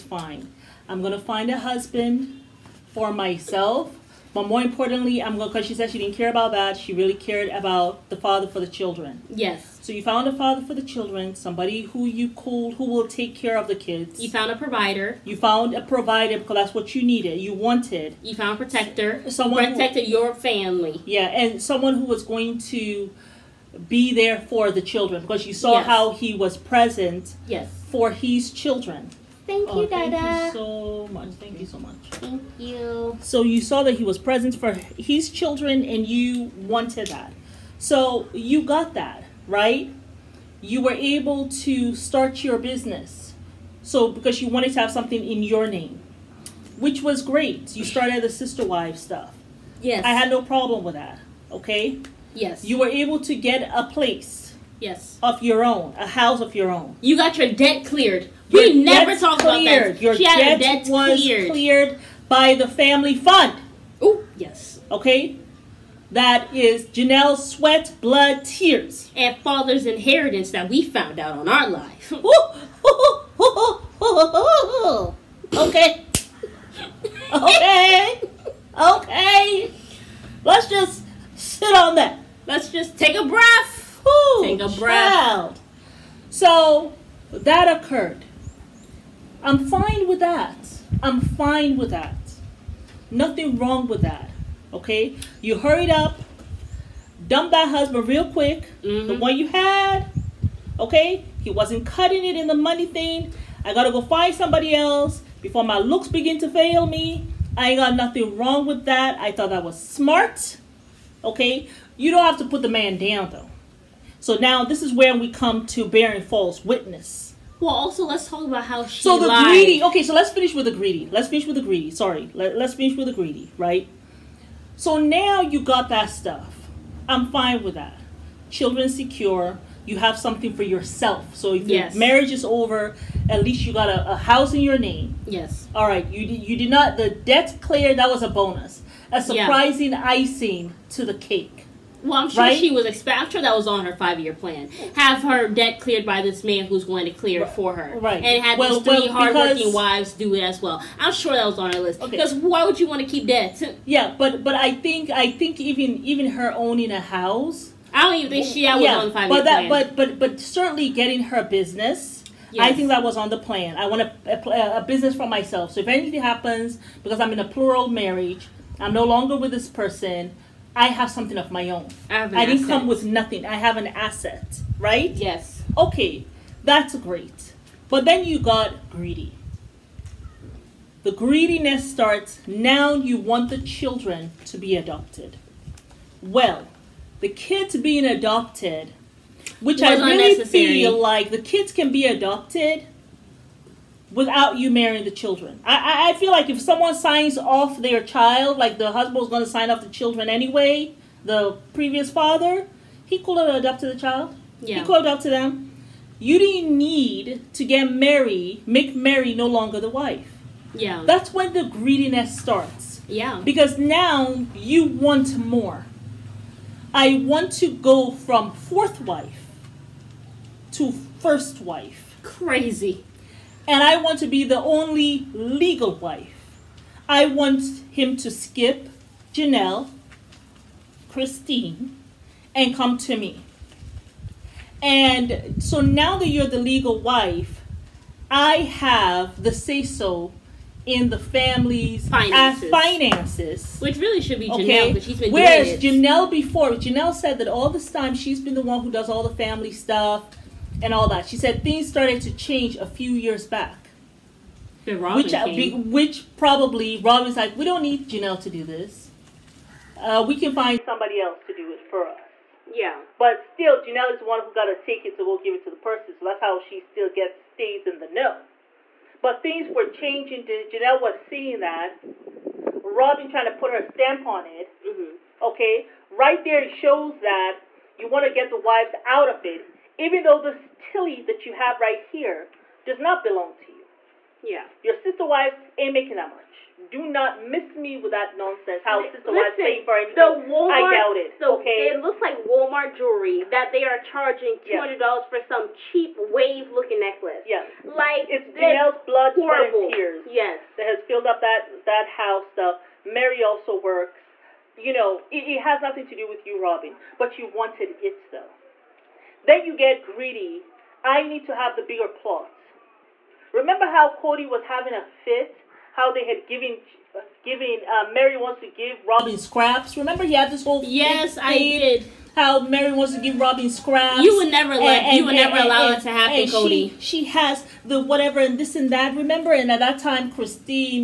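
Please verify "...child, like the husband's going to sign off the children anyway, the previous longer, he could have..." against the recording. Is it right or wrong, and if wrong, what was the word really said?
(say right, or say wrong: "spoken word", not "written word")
wrong: "father", not "longer".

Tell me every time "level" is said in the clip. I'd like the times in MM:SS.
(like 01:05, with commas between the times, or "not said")
not said.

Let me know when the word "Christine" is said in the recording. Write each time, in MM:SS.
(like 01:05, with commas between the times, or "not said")
03:51, 05:30.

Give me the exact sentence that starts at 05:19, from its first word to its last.
Remember he had this whole yes, I did.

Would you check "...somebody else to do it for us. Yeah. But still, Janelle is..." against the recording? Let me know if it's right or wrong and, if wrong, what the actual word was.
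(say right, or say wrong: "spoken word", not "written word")
right.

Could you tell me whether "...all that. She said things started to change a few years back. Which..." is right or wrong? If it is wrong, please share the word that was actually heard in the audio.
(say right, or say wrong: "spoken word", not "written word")
right.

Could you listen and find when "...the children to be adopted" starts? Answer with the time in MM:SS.
03:03.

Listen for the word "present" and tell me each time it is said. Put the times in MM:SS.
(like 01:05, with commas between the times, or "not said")
00:26, 00:34.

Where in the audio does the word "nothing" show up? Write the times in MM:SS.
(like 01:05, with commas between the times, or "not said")
01:33, 01:47, 02:53, 05:05.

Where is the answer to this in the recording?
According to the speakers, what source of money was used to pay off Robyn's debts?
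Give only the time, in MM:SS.
01:02.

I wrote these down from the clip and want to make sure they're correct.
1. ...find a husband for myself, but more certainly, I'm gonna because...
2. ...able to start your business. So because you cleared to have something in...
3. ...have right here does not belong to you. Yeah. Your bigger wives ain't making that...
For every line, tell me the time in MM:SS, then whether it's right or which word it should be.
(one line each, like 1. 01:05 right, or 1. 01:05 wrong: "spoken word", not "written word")
1. 00:01 wrong: "importantly", not "certainly"
2. 00:40 wrong: "wanted", not "cleared"
3. 04:41 wrong: "sister", not "bigger".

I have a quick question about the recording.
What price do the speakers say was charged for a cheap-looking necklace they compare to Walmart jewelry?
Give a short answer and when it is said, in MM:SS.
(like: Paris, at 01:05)
$200, at 04:54.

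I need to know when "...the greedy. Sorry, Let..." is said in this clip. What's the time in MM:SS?
02:01.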